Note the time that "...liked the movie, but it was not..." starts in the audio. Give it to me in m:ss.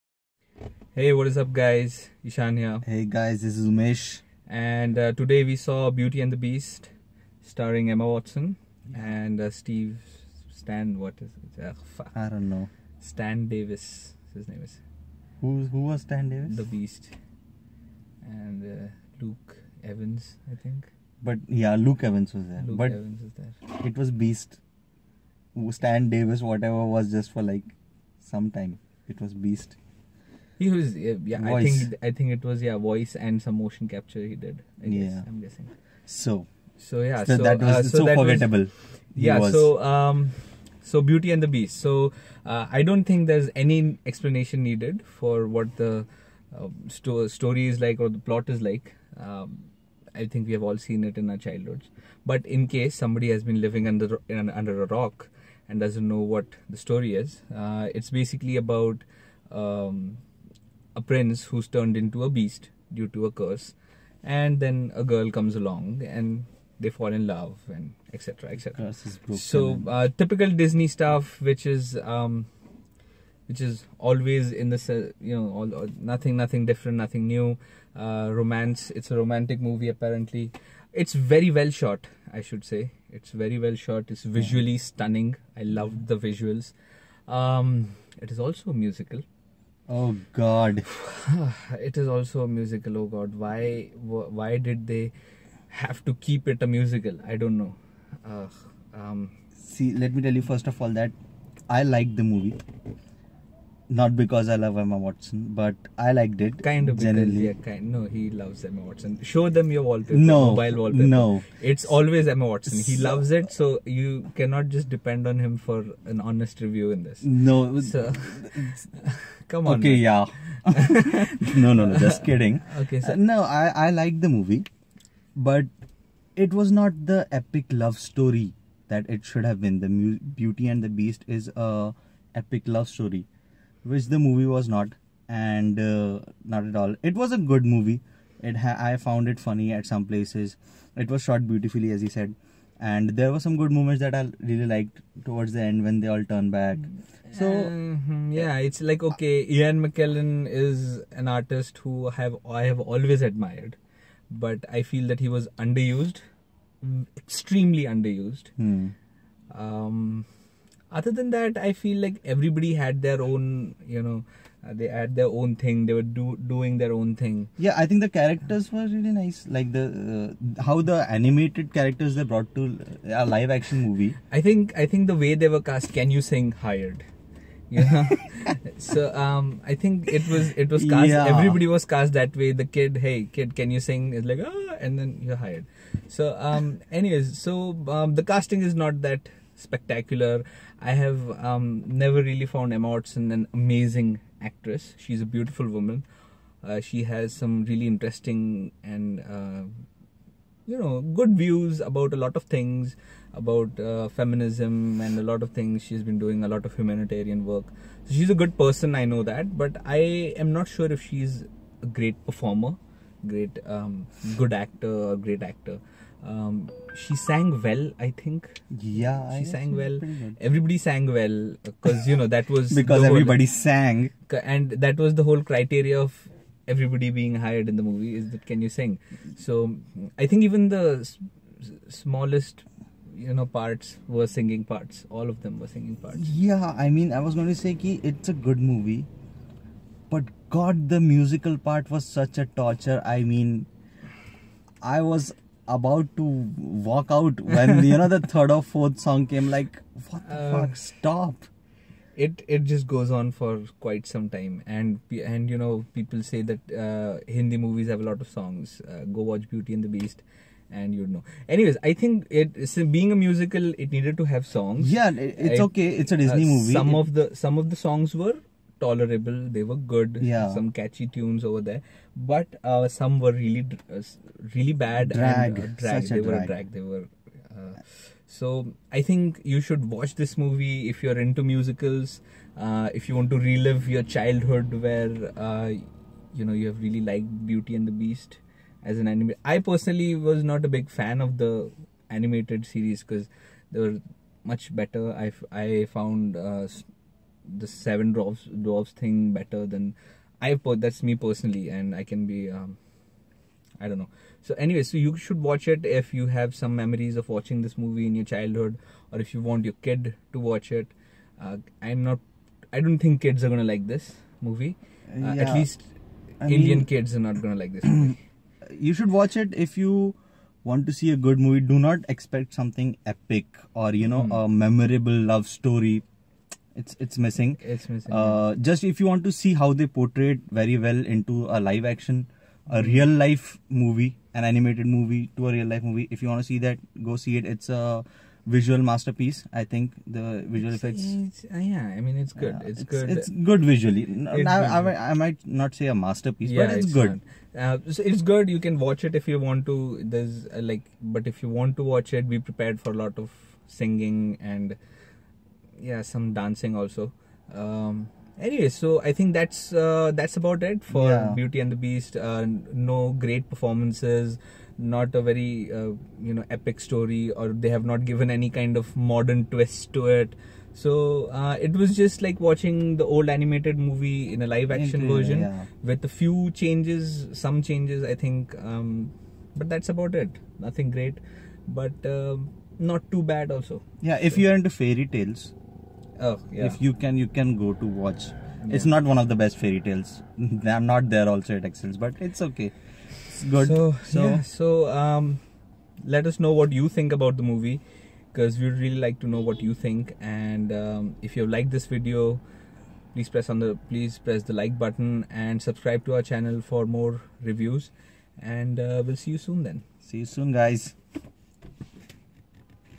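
2:03.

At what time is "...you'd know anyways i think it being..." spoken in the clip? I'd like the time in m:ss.
4:20.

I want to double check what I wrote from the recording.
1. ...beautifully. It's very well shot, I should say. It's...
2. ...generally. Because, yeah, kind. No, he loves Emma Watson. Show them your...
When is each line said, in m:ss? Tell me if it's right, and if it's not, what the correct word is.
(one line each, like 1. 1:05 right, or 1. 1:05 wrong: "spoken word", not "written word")
1. 1:19 wrong: "apparently", not "beautifully"
2. 1:46 right.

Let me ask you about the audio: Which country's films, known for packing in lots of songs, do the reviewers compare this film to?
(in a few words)
Hindi movies.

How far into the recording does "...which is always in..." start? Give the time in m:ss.
1:13.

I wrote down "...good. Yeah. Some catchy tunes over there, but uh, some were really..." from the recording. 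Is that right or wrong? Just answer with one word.
right.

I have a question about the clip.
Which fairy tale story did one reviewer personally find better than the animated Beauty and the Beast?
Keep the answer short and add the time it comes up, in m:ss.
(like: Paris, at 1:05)
Seven Dwarfs, at 4:57.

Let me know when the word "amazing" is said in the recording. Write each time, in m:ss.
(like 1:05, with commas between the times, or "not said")
3:13.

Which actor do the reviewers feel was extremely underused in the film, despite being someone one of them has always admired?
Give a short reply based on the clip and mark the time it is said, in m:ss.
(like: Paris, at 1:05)
Ian McKellen, at 2:29.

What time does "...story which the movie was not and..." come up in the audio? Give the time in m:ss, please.
2:12.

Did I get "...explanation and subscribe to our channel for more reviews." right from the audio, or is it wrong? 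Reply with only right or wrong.
wrong.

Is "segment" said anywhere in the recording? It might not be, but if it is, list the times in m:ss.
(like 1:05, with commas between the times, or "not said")
not said.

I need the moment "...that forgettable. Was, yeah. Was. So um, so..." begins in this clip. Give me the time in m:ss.
0:38.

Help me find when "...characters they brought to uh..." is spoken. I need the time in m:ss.
2:51.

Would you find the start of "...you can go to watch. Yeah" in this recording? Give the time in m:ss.
6:27.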